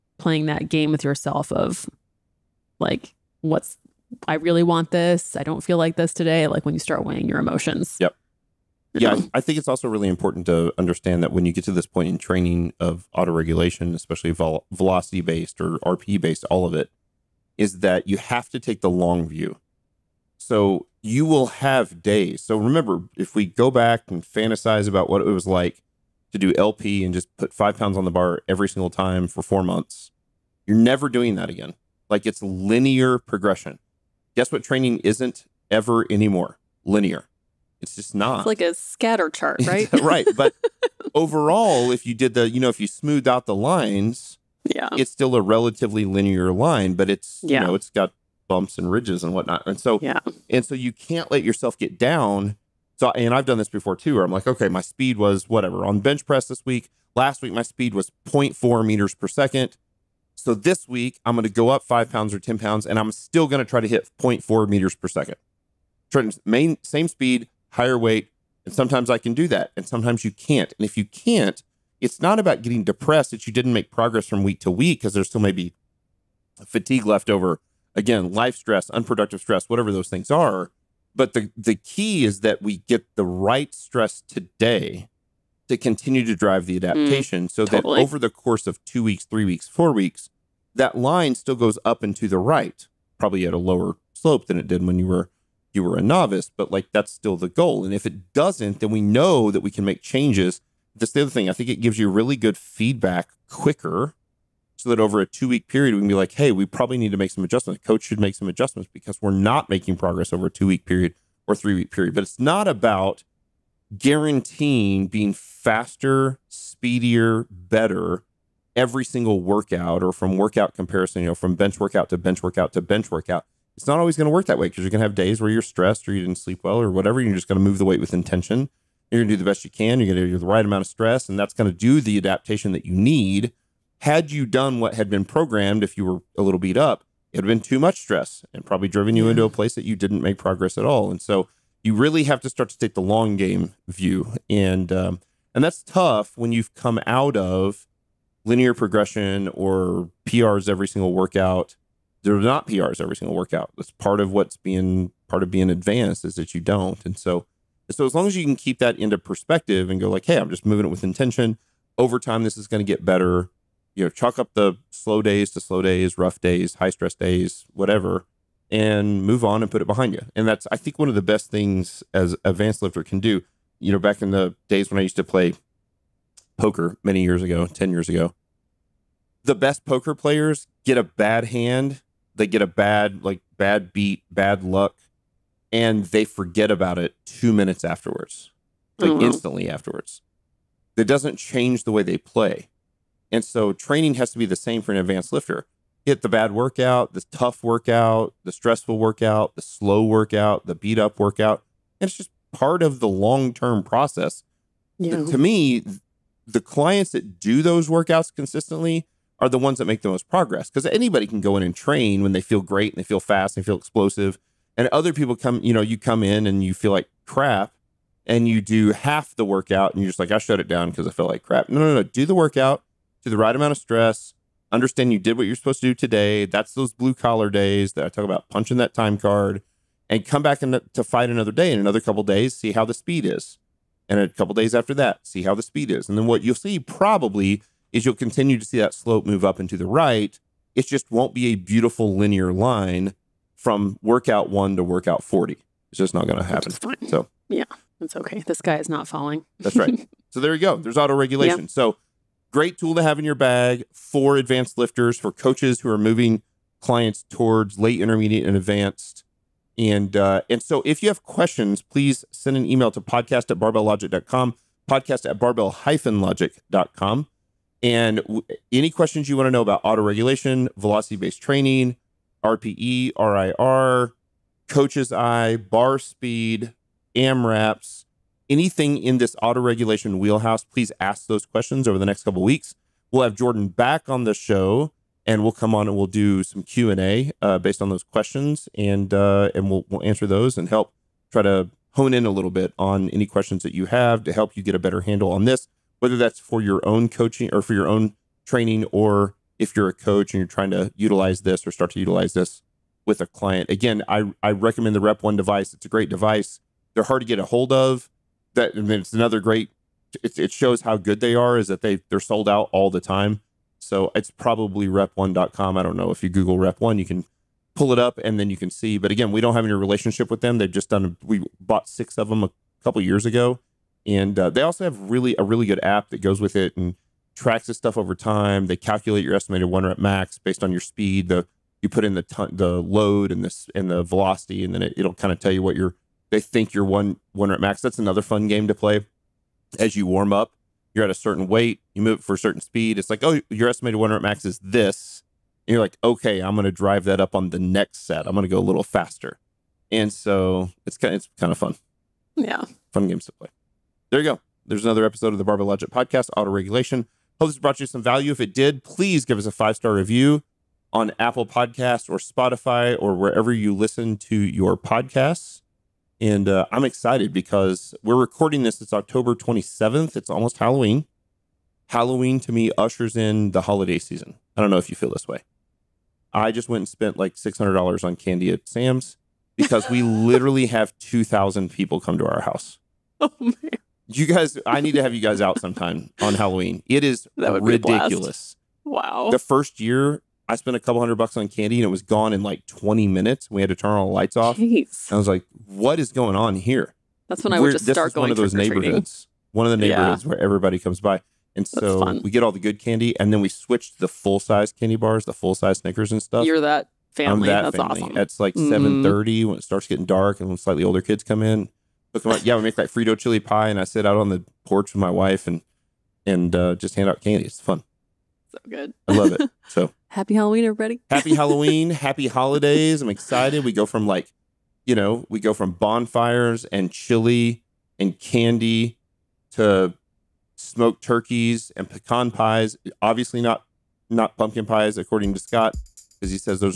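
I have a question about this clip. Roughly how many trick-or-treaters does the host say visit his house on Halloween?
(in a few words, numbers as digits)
2,000.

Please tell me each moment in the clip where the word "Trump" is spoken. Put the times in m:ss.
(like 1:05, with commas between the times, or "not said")
not said.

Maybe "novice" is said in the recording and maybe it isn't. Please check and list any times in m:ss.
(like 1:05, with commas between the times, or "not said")
1:36.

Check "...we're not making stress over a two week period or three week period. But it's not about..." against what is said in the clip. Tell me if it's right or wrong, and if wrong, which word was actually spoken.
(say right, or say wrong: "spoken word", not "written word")
wrong: "progress", not "stress".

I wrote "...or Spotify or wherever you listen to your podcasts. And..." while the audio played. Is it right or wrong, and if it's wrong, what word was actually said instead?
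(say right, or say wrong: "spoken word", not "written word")
right.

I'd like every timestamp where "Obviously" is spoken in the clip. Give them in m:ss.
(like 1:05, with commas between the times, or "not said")
7:13.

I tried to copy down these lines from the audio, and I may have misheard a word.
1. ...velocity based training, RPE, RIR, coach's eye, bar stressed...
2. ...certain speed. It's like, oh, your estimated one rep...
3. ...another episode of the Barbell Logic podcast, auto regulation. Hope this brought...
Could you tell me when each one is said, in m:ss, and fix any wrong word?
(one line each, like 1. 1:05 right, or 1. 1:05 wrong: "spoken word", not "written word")
1. 4:30 wrong: "speed", not "stressed"
2. 5:42 right
3. 5:54 right.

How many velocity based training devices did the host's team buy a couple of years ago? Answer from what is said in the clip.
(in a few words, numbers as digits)
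6.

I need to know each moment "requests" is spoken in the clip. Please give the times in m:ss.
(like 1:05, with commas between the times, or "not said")
not said.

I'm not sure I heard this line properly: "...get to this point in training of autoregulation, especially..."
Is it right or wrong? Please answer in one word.
right.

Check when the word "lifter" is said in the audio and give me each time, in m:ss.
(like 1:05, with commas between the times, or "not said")
2:52, 3:15, 4:14.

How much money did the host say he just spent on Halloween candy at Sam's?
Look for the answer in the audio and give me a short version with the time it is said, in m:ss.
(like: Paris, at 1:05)
$600, at 6:17.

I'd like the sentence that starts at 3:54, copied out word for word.
And a couple days after that, see how the speed is.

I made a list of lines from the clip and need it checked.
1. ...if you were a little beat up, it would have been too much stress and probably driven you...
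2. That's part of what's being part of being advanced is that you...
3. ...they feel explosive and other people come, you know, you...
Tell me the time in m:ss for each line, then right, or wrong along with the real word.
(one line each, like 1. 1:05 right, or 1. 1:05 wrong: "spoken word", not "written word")
1. 2:15 right
2. 2:33 right
3. 3:33 right.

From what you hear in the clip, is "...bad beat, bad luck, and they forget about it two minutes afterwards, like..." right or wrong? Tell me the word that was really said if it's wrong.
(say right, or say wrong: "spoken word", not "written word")
right.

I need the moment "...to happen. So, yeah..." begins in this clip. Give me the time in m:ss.
4:06.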